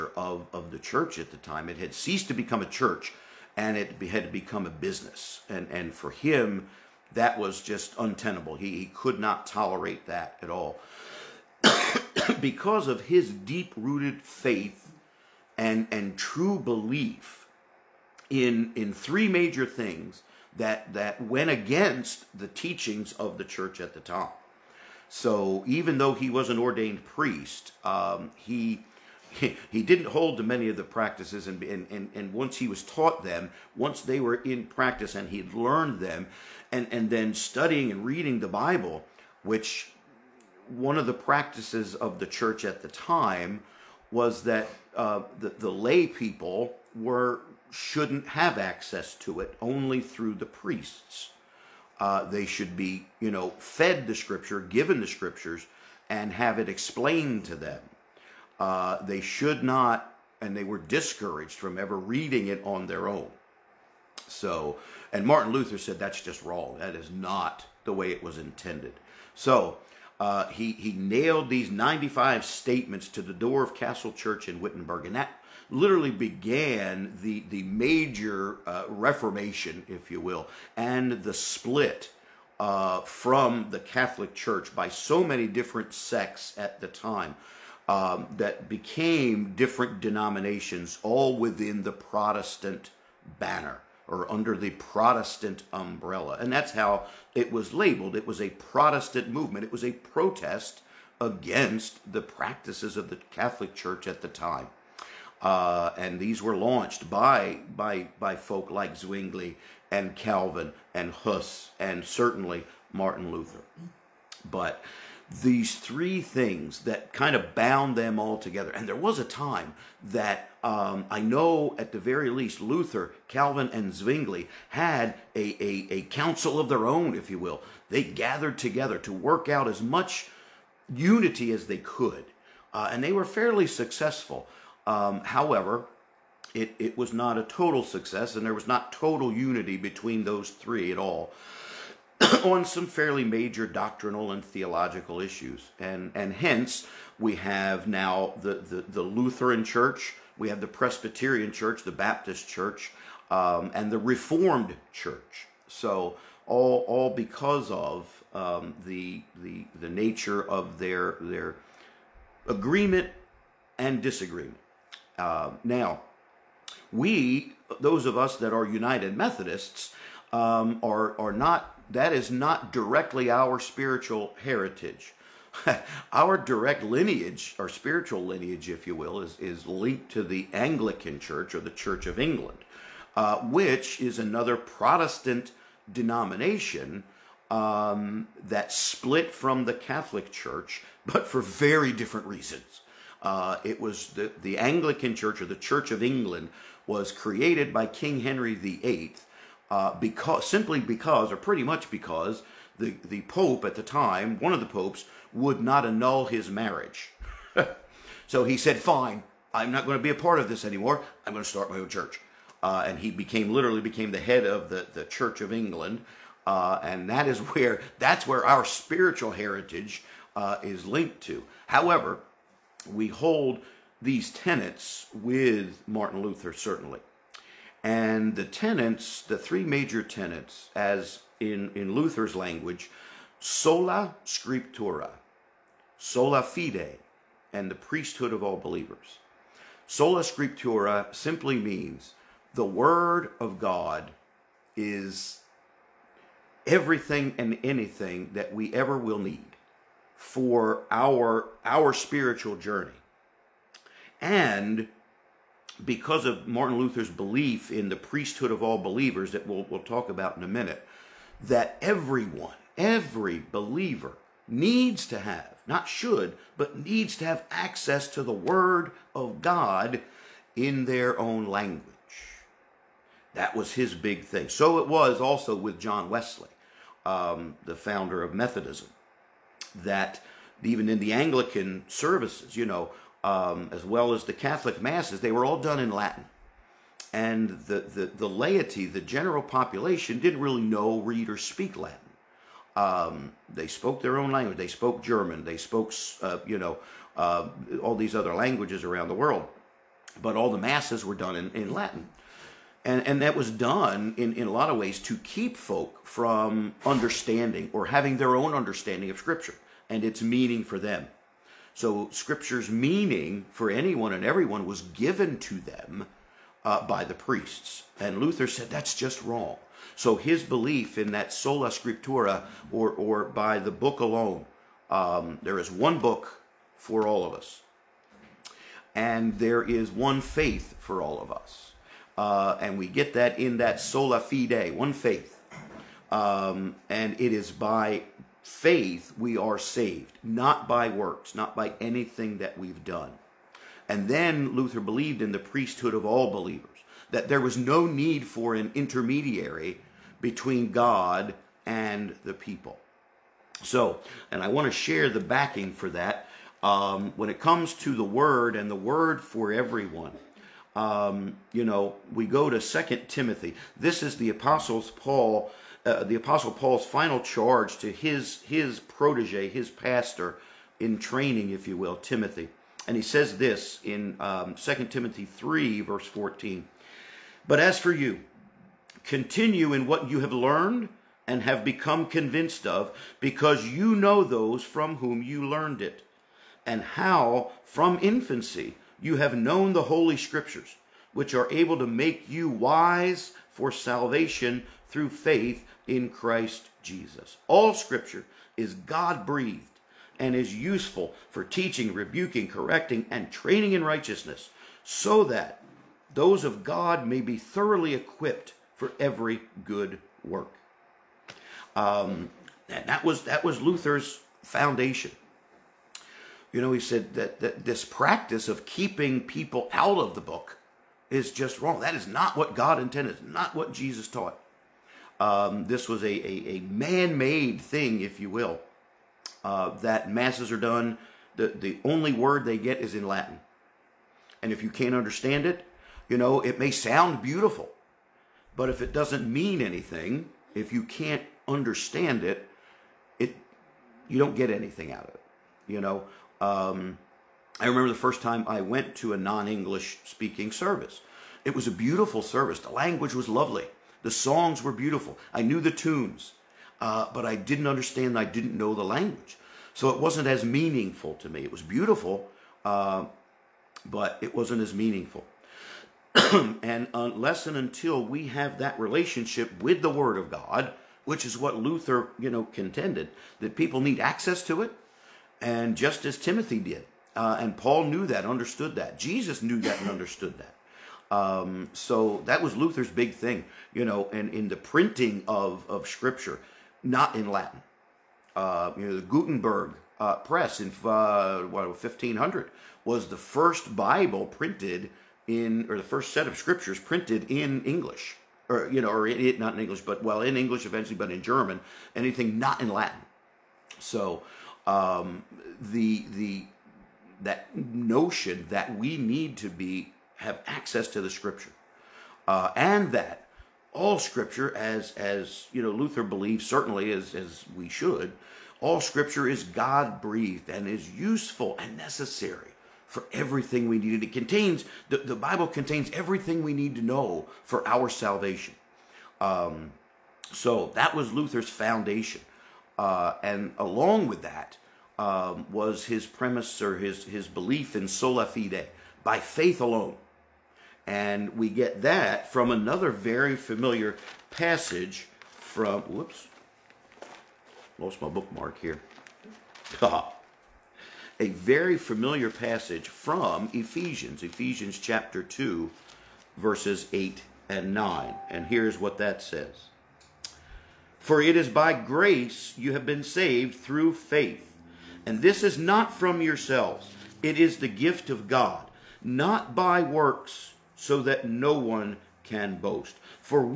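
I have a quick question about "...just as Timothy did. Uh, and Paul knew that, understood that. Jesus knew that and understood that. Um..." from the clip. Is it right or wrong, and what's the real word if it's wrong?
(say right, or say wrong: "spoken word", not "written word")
right.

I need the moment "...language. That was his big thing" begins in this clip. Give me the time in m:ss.
4:31.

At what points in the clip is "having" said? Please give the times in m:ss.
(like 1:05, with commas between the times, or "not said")
5:07.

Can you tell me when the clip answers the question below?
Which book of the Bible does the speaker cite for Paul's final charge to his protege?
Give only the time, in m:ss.
6:02.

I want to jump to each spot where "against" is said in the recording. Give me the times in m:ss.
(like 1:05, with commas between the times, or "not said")
0:21, 1:41.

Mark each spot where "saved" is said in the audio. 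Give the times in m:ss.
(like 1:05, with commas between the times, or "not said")
5:39, 9:23.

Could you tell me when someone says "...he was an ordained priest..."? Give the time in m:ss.
0:26.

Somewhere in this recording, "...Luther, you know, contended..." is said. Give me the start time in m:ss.
7:51.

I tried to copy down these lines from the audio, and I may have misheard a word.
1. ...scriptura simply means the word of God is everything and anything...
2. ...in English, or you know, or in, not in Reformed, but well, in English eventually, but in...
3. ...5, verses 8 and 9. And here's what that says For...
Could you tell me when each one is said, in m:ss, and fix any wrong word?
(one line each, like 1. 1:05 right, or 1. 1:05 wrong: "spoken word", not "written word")
1. 4:00 right
2. 8:17 wrong: "English", not "Reformed"
3. 9:15 wrong: "2", not "5".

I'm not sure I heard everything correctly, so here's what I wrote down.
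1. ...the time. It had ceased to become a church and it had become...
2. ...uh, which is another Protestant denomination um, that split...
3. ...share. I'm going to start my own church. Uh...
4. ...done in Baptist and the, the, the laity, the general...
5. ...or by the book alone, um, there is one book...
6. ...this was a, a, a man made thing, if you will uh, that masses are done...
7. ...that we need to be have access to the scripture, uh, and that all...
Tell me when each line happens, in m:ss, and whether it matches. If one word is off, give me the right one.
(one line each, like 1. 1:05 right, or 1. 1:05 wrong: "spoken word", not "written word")
1. 0:01 right
2. 3:03 right
3. 3:30 wrong: "anymore", not "share"
4. 4:45 wrong: "Latin", not "Baptist"
5. 5:22 right
6. 7:05 right
7. 8:28 right.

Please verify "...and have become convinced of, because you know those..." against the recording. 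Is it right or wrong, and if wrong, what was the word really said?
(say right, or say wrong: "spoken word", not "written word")
right.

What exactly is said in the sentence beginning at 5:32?
Uh, and we get that in that sola fide, one faith.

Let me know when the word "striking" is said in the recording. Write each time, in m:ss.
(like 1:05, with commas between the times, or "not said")
not said.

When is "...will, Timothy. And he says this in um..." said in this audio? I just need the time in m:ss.
6:11.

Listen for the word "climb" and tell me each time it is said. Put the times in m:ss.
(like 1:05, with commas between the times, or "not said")
not said.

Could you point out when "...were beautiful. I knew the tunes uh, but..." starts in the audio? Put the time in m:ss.
7:34.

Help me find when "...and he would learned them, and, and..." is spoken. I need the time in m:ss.
0:35.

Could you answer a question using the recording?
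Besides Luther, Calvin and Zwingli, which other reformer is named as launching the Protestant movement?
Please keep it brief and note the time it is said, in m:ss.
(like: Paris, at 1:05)
Huss, at 1:51.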